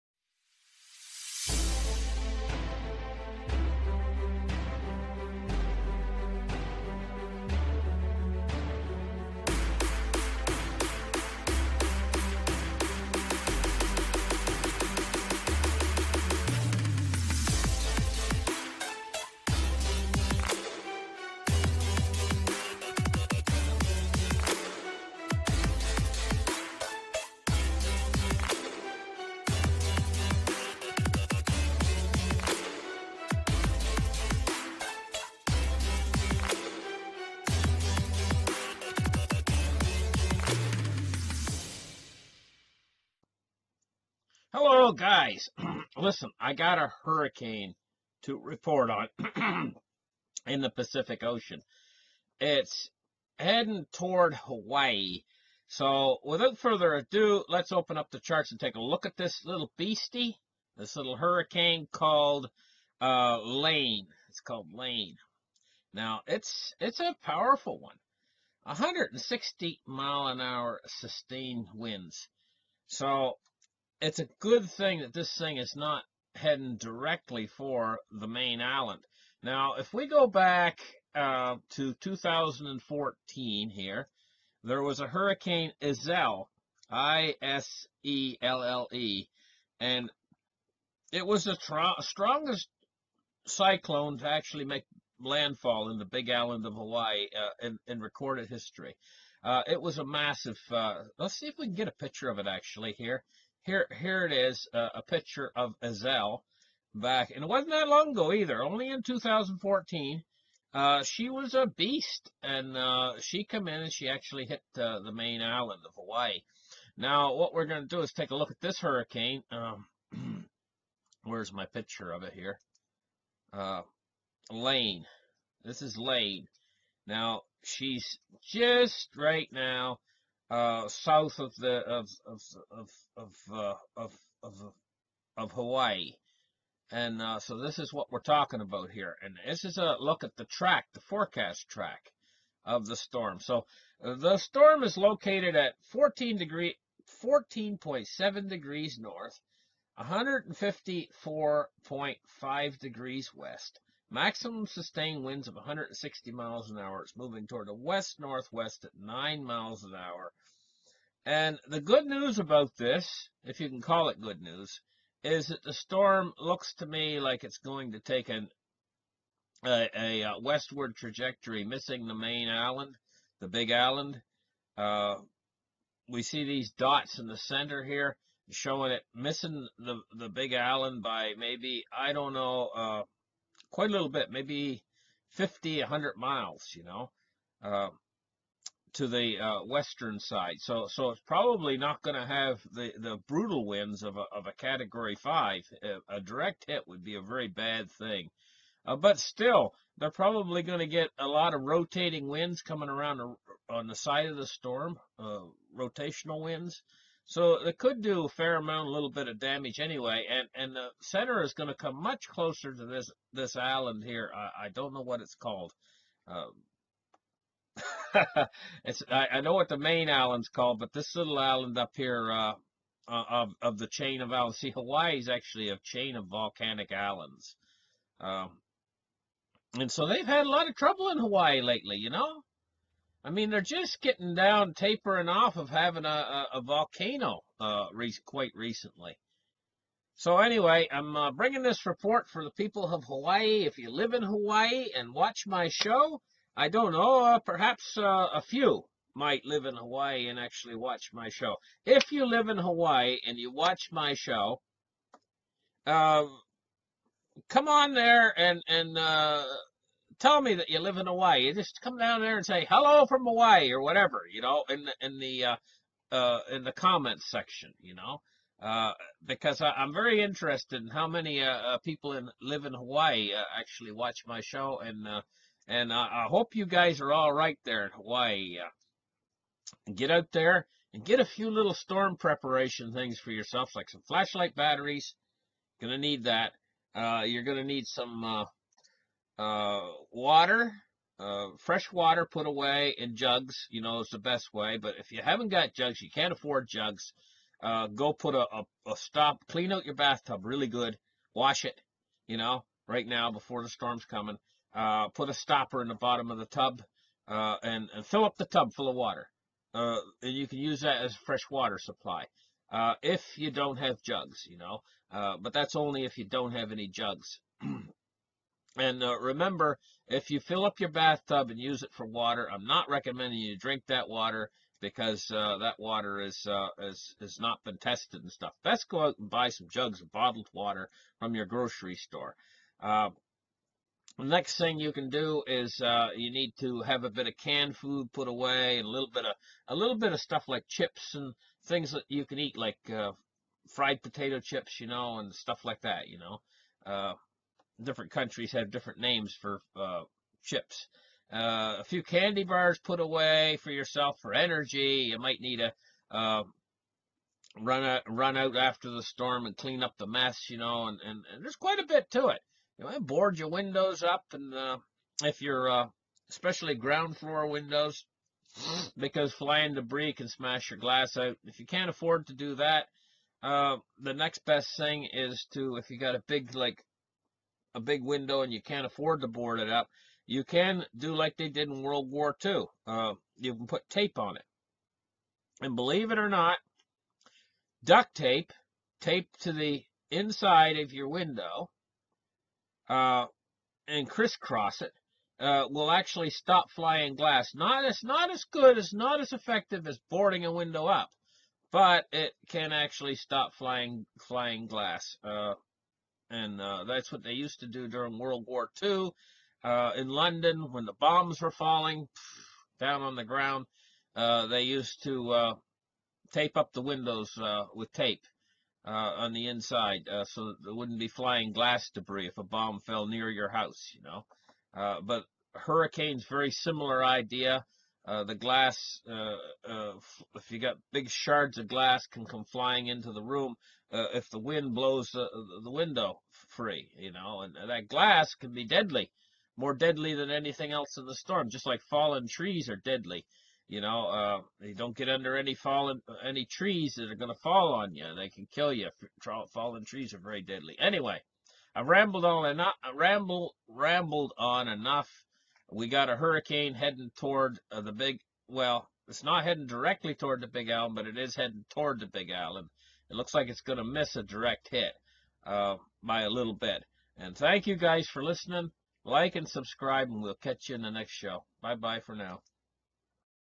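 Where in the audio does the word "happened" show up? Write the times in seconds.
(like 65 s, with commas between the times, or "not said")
not said.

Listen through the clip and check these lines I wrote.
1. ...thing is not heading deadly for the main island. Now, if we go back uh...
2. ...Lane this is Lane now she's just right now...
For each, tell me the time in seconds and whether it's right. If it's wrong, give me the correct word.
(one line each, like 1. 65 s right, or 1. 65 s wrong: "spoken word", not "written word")
1. 75 s wrong: "directly", not "deadly"
2. 124 s right.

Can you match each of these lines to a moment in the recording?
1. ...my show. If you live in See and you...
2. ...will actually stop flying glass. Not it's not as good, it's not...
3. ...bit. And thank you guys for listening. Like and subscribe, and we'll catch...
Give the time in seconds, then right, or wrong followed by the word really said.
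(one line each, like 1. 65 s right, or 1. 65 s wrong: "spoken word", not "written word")
1. 251 s wrong: "Hawaii", not "See"
2. 395 s right
3. 466 s right.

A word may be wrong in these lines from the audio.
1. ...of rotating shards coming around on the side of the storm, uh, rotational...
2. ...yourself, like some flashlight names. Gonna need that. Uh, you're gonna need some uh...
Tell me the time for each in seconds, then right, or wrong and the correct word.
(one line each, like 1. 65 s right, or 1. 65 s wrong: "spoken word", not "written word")
1. 201 s wrong: "winds", not "shards"
2. 283 s wrong: "batteries", not "names".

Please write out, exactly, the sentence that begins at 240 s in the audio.
So anyway, I'm uh, bringing this report for the people of Hawaii.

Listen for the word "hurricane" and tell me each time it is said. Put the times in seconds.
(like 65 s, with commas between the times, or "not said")
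47 s, 61 s, 85 s, 118 s, 425 s, 456 s.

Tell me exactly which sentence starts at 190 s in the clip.
So so it's probably not going to have the, the brutal winds of a, of a Category 5.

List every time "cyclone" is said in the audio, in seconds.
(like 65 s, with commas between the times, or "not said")
93 s.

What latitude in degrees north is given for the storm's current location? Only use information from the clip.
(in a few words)
14.7 degrees north.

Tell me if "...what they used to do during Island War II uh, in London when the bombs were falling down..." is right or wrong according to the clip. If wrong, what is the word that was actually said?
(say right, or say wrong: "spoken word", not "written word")
wrong: "World", not "Island".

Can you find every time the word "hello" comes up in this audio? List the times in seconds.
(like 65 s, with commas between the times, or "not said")
44 s, 262 s.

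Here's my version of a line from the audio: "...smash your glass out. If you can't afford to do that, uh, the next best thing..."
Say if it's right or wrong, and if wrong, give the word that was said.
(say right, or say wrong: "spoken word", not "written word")
right.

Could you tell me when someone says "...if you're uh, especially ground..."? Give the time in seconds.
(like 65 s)
365 s.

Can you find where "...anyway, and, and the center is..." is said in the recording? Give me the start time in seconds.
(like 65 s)
209 s.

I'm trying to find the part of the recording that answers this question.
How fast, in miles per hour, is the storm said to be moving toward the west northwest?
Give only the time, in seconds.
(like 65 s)
158 s.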